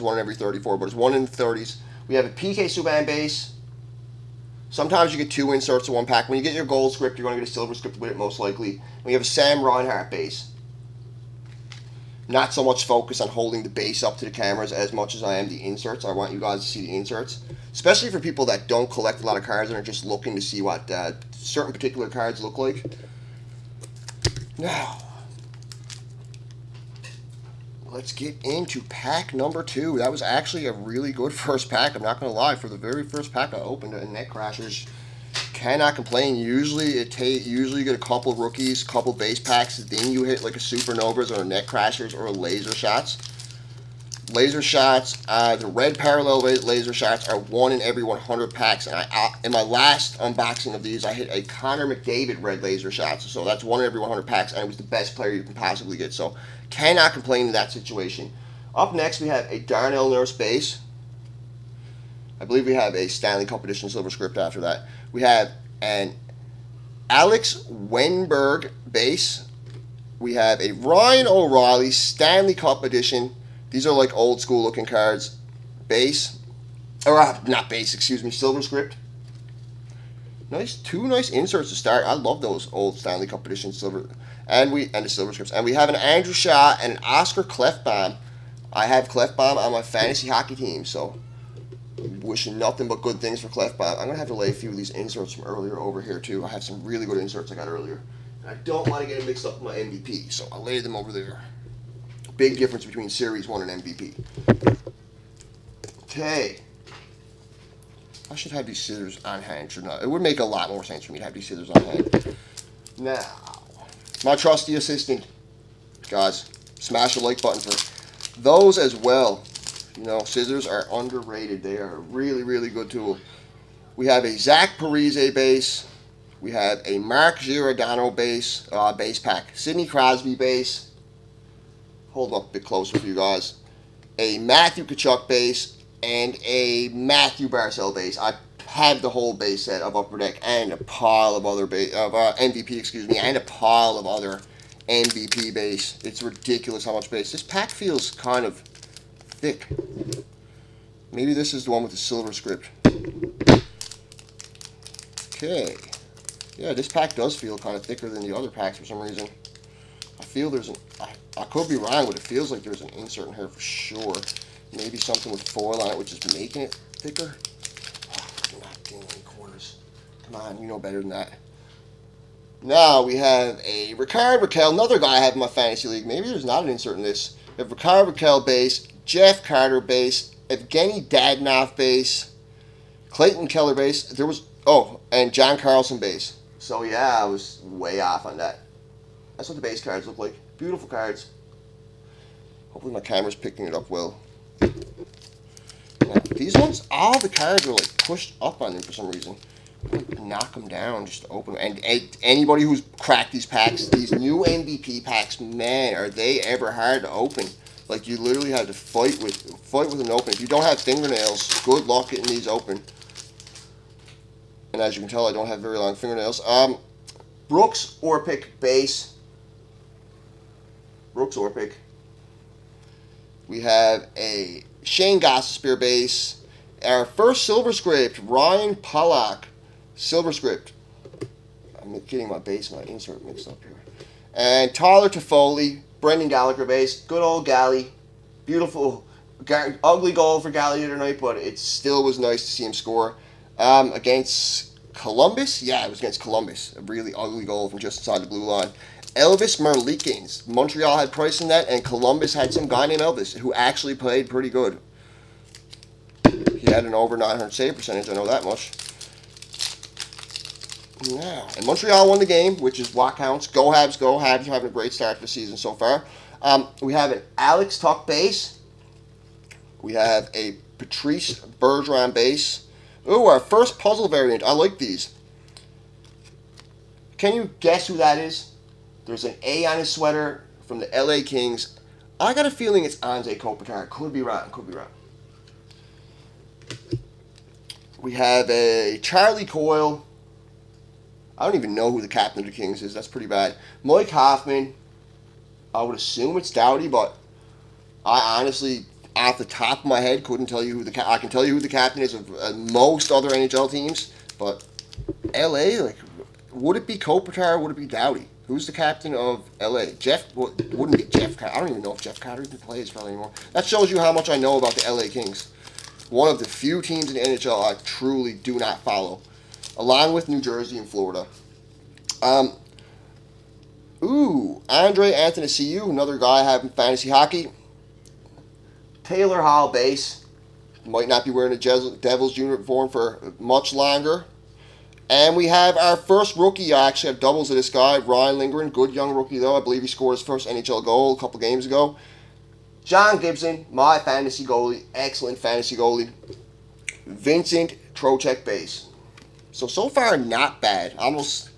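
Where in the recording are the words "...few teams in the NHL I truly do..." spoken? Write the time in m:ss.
5:16.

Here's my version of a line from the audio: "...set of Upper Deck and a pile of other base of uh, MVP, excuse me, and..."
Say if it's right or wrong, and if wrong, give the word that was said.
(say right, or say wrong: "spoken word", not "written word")
right.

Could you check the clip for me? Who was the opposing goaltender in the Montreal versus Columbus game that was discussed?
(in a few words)
Elvis Merzlikins.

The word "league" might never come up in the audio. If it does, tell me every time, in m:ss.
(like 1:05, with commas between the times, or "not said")
2:55.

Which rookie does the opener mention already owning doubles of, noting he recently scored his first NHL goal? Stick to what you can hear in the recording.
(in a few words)
Ryan Lindgren.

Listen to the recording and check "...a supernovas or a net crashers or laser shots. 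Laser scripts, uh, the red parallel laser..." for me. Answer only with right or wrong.
wrong.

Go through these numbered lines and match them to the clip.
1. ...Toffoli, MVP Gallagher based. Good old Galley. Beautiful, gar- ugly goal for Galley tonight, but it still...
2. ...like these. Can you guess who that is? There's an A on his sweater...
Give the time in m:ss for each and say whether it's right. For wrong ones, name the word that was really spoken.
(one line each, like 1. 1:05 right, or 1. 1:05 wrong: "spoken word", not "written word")
1. 3:55 wrong: "Brendan", not "MVP"
2. 4:34 right.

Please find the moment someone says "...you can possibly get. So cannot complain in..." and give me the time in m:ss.
0:55.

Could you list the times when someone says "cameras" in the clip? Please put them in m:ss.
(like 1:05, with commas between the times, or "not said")
0:14, 3:12.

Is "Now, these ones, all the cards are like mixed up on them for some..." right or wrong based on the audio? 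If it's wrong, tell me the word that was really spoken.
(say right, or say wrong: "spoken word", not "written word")
wrong: "pushed", not "mixed".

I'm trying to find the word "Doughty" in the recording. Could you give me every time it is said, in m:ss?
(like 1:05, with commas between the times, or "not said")
4:56, 5:07.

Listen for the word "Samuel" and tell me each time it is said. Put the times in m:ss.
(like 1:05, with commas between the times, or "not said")
not said.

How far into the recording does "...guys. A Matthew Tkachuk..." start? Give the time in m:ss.
2:13.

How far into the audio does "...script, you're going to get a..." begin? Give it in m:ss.
0:06.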